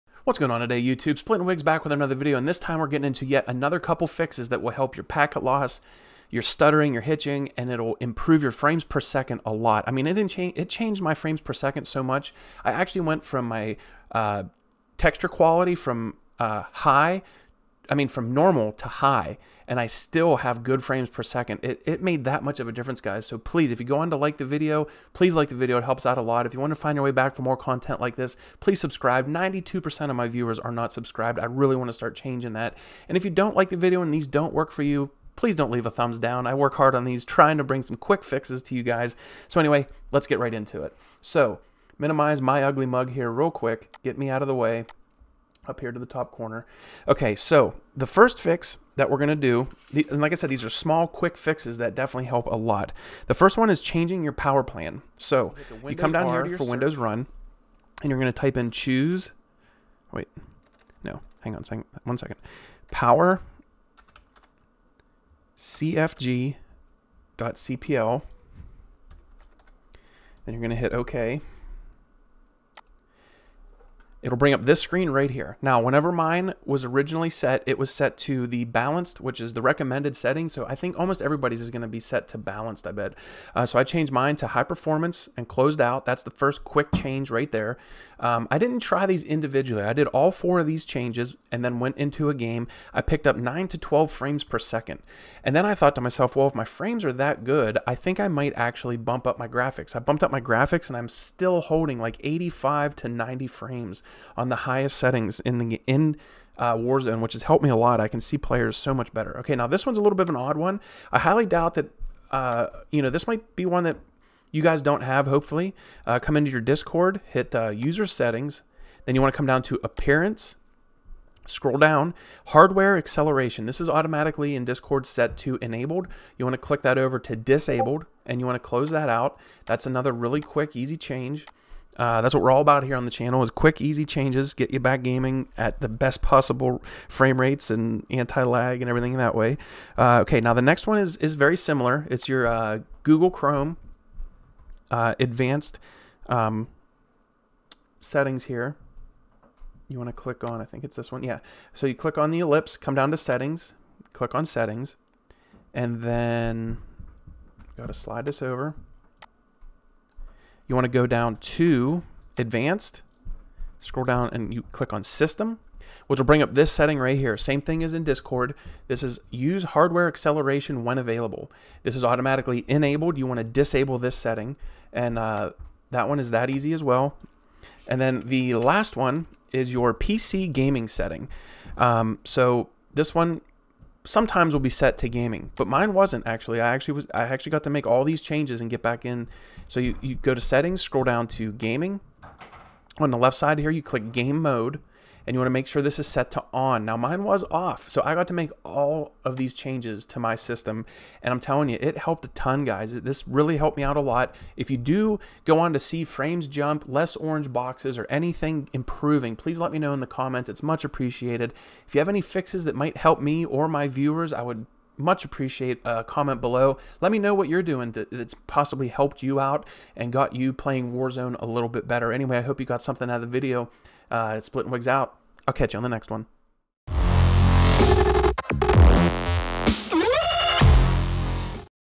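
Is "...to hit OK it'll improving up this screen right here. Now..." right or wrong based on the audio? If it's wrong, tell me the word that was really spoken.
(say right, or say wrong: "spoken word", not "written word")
wrong: "bring", not "improving".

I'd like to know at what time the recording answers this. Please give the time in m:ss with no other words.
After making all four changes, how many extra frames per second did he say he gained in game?
1:33.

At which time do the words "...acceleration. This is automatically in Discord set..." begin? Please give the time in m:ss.
2:02.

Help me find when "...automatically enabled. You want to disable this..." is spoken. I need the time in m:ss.
2:52.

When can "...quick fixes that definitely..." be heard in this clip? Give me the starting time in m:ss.
0:51.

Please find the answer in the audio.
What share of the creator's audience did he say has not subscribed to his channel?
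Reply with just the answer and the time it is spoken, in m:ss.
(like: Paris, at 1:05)
92%, at 0:29.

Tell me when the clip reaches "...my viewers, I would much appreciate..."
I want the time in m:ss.
3:33.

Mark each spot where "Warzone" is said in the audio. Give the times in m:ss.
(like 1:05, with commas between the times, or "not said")
1:46, 3:40.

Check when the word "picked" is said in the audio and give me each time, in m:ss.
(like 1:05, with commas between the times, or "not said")
1:33.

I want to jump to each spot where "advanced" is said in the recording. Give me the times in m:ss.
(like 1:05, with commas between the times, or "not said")
2:25, 2:42.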